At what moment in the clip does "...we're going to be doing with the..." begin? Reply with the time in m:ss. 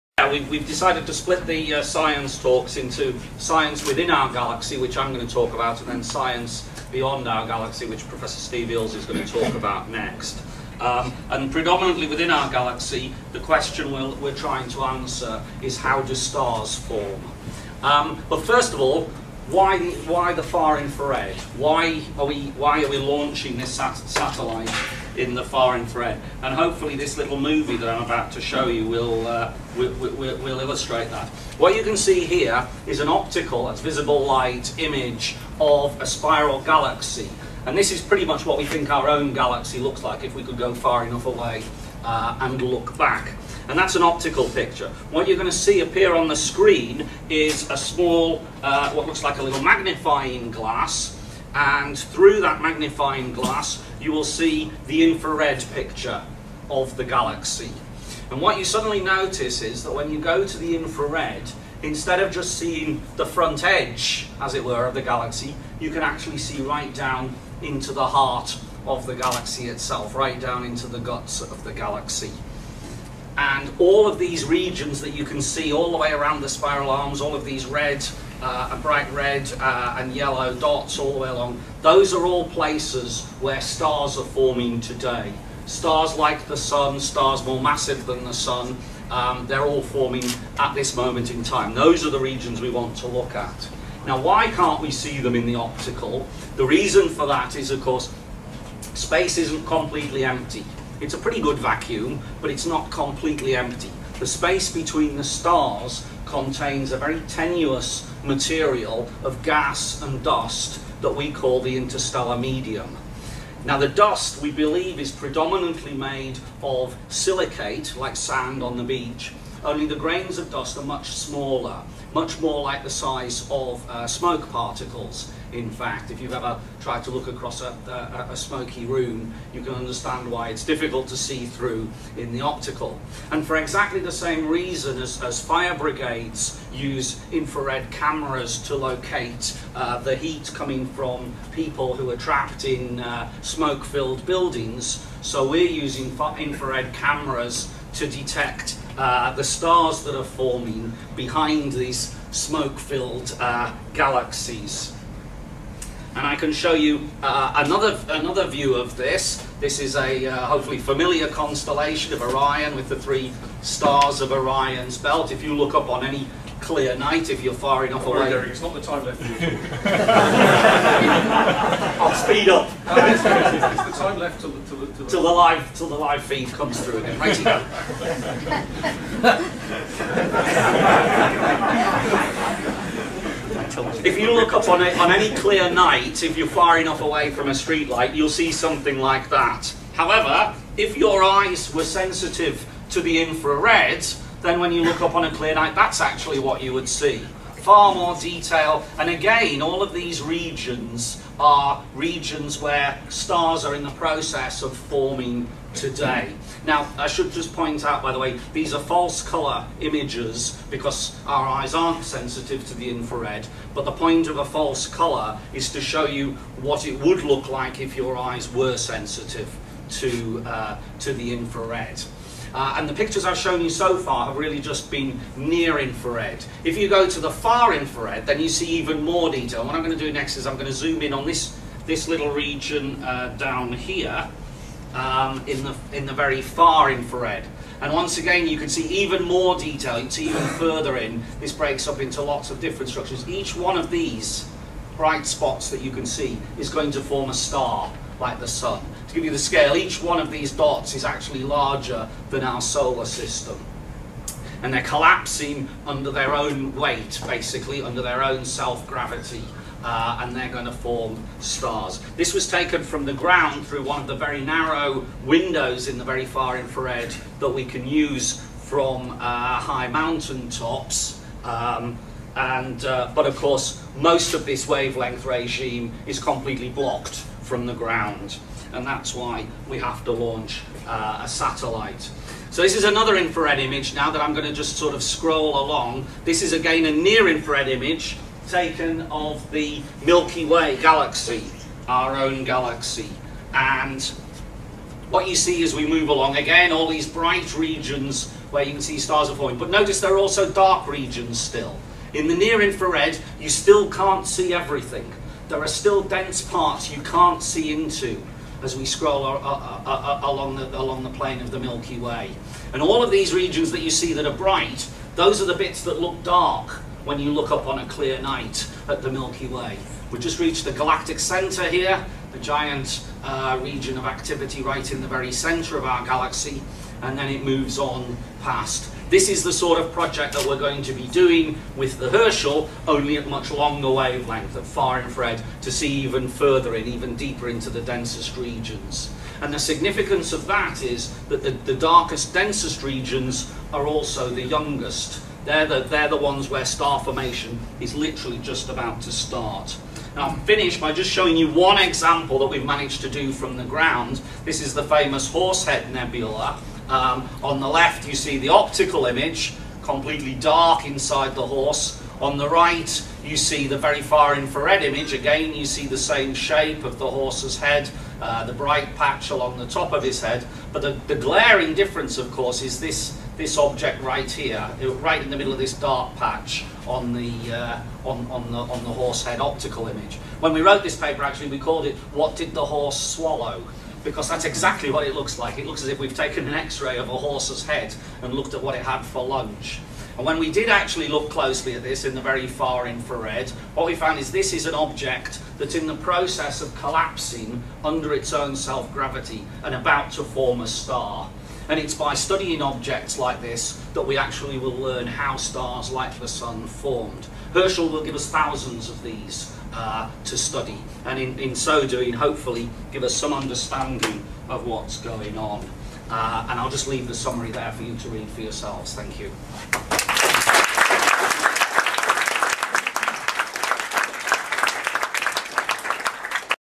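5:30.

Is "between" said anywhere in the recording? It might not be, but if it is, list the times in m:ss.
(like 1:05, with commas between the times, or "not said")
1:44.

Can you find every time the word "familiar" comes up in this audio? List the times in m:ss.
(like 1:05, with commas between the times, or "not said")
2:40.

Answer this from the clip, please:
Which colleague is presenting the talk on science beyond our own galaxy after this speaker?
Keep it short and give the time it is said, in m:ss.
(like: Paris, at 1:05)
Steve Eales, at 0:08.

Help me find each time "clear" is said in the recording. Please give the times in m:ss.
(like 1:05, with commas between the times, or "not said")
2:46, 3:05, 3:15, 5:17.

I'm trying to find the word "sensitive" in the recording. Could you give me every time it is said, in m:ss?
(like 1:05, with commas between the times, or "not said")
3:11, 3:32, 3:38.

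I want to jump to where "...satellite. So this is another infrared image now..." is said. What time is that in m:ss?
4:41.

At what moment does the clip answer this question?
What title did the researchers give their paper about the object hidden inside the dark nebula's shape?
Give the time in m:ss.
6:22.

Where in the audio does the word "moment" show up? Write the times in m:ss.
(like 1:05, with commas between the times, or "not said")
1:30.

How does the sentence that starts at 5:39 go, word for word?
And the significance of that is that the, the darkest, densest regions are also the youngest.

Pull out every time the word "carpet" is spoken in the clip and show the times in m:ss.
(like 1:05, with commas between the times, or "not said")
not said.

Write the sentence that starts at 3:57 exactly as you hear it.
And once again, you can see even more detail.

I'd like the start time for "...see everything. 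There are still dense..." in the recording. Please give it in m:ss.
5:04.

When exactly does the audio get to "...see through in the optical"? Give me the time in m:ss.
2:11.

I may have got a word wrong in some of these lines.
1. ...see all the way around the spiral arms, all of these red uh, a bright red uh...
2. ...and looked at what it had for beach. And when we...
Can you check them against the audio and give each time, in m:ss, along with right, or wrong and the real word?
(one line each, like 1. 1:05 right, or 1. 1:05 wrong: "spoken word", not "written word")
1. 1:15 right
2. 6:28 wrong: "lunch", not "beach".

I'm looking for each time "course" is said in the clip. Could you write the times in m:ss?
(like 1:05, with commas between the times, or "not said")
1:37, 4:33, 6:12.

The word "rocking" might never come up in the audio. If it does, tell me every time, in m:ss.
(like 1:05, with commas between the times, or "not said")
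not said.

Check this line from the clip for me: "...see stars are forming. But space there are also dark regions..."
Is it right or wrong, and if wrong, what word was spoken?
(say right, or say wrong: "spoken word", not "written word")
wrong: "notice", not "space".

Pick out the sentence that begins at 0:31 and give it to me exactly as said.
What you can see here is an optical, that's visible light, image of a spiral galaxy.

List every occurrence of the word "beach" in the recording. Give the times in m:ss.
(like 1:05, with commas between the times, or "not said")
1:58.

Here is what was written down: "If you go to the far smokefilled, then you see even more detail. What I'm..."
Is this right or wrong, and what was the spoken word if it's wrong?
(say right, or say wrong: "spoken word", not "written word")
wrong: "infrared", not "smokefilled".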